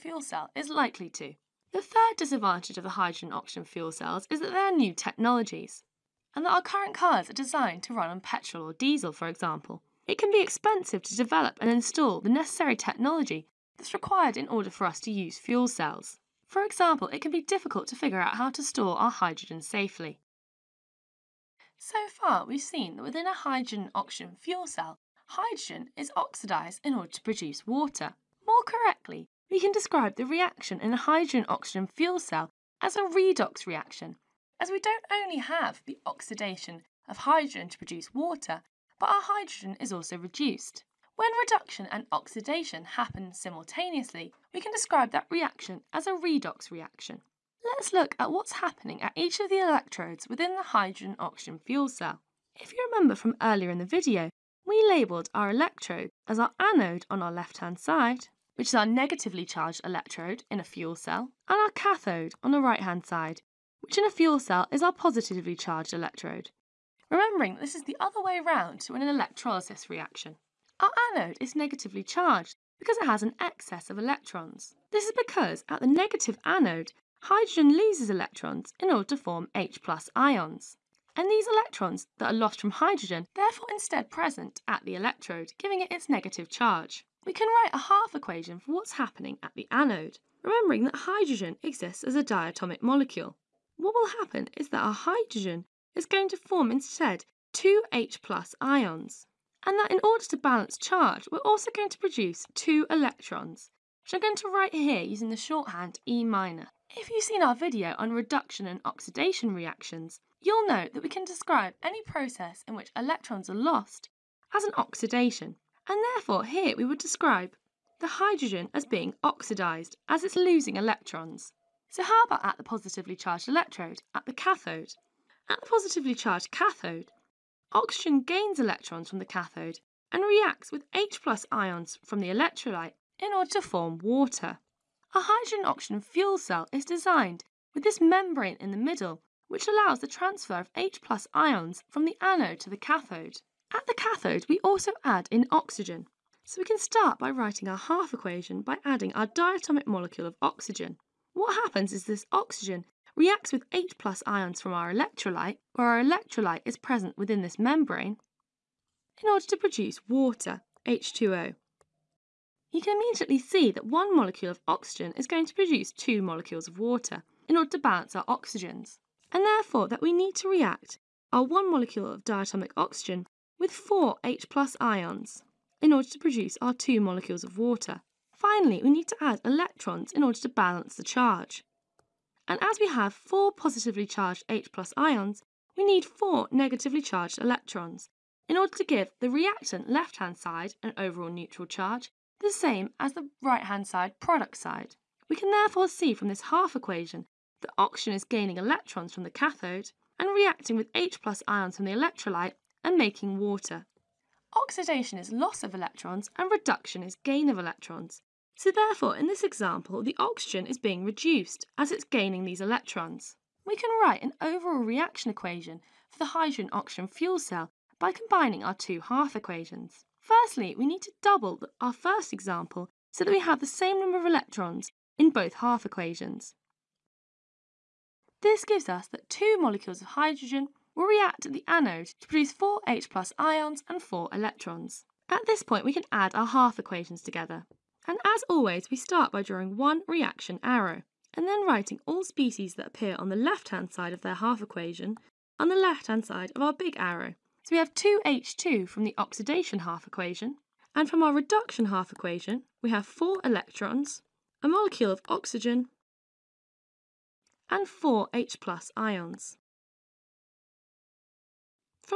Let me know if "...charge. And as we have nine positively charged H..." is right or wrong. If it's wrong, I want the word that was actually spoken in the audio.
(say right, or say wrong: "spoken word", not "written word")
wrong: "four", not "nine".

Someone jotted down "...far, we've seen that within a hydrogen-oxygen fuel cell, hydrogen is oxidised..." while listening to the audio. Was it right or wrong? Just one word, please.
right.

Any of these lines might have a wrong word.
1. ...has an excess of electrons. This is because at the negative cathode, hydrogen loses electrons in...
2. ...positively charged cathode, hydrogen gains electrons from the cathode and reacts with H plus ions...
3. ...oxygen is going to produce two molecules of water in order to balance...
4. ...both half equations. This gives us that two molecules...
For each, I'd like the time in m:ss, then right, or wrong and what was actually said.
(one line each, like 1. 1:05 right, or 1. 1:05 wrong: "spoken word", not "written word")
1. 1:13 wrong: "anode", not "cathode"
2. 2:05 wrong: "oxygen", not "hydrogen"
3. 2:44 right
4. 3:45 right.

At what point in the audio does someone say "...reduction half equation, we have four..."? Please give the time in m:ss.
4:11.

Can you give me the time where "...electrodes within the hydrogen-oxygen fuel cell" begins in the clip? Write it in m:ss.
0:49.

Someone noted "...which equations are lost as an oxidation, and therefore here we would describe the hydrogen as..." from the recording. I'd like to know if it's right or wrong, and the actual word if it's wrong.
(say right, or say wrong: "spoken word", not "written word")
wrong: "electrons", not "equations".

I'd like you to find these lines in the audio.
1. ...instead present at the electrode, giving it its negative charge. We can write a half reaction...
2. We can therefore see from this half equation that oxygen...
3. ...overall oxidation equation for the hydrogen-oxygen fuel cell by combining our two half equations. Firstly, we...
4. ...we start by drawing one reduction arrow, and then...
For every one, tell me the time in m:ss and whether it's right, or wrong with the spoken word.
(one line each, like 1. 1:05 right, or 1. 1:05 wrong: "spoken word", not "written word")
1. 1:23 wrong: "equation", not "reaction"
2. 3:15 right
3. 3:34 wrong: "reaction", not "oxidation"
4. 3:58 wrong: "reaction", not "reduction".